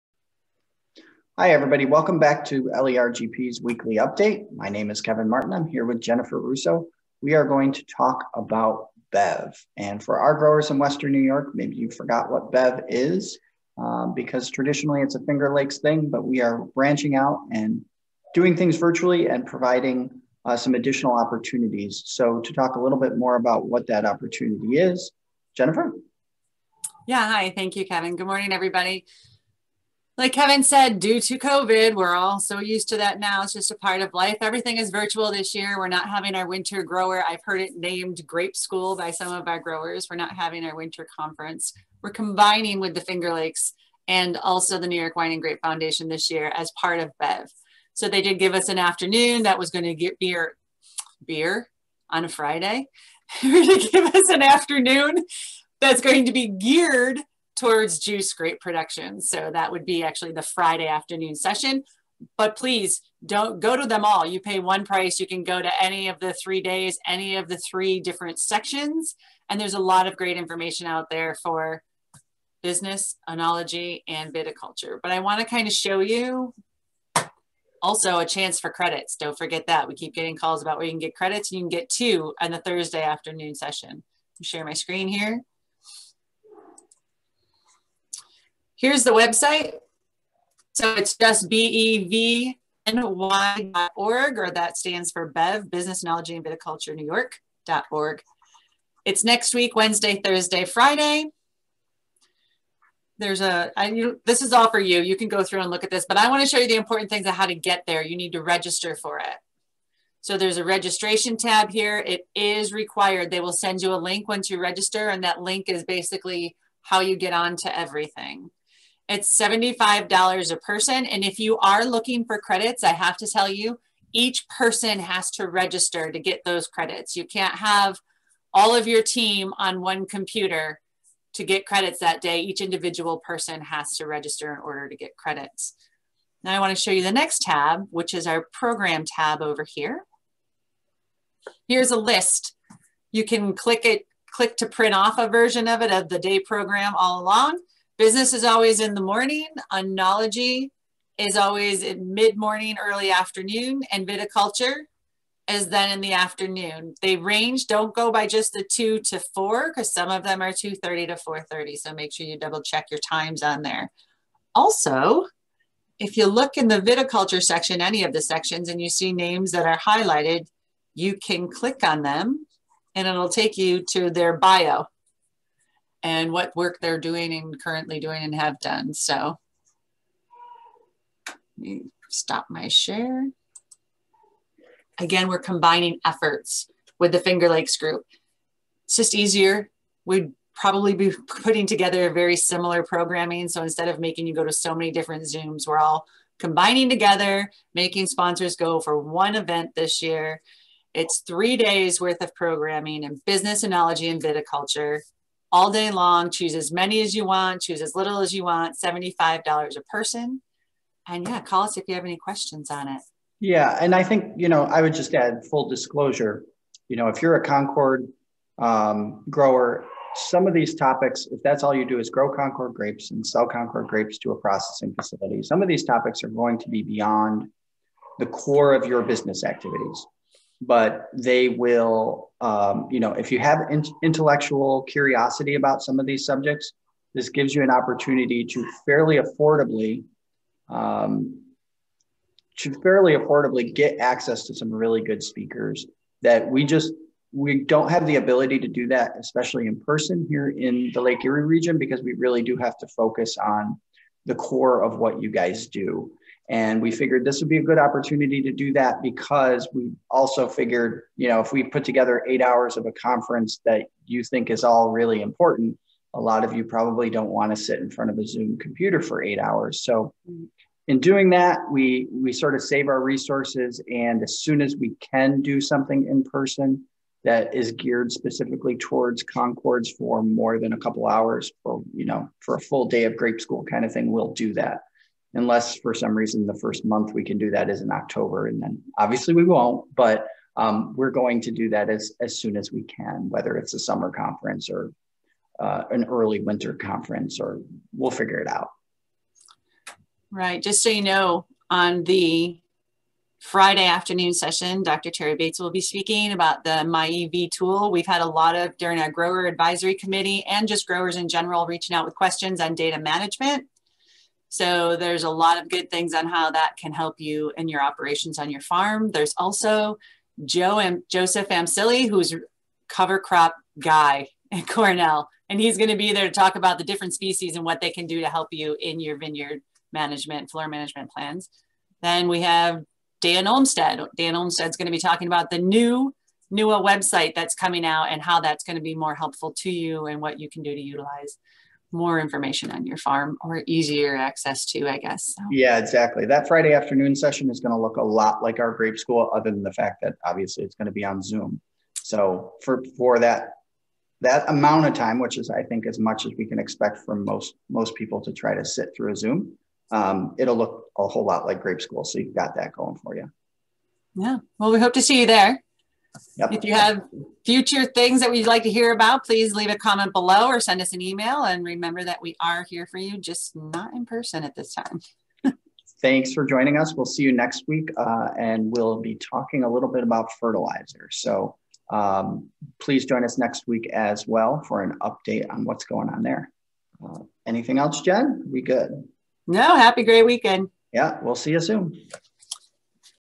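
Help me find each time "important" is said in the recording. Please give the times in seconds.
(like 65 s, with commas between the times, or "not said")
106 s, 265 s.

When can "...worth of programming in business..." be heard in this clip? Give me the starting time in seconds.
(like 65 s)
202 s.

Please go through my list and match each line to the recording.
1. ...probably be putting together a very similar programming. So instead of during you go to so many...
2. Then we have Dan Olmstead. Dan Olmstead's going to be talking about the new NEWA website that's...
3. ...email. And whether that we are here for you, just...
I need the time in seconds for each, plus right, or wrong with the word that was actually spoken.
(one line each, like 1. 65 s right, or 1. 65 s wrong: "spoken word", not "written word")
1. 190 s wrong: "making", not "during"
2. 332 s right
3. 371 s wrong: "remember", not "whether".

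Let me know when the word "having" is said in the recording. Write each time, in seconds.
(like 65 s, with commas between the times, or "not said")
36 s, 40 s.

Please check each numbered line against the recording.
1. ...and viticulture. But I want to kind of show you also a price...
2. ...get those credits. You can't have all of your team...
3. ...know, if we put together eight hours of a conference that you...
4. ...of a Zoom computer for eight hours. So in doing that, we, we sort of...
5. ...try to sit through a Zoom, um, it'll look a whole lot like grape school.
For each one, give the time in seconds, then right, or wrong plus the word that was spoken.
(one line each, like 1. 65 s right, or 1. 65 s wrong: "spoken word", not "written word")
1. 74 s wrong: "chance", not "price"
2. 126 s right
3. 261 s right
4. 268 s right
5. 358 s right.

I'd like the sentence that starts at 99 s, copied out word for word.
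It's next week, Wednesday, Thursday, Friday.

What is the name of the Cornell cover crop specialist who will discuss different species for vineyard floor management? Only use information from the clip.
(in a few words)
Joseph Amsili.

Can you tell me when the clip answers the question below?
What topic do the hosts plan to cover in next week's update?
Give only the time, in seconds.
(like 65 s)
380 s.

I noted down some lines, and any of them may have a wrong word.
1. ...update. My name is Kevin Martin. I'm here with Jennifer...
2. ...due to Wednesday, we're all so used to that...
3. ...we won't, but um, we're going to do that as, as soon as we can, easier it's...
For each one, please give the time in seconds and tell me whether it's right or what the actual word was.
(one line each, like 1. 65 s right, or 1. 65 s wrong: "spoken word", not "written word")
1. 3 s right
2. 30 s wrong: "COVID", not "Wednesday"
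3. 289 s wrong: "whether", not "easier".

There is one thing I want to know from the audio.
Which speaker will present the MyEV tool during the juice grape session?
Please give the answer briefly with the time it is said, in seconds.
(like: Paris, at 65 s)
Terry Bates, at 304 s.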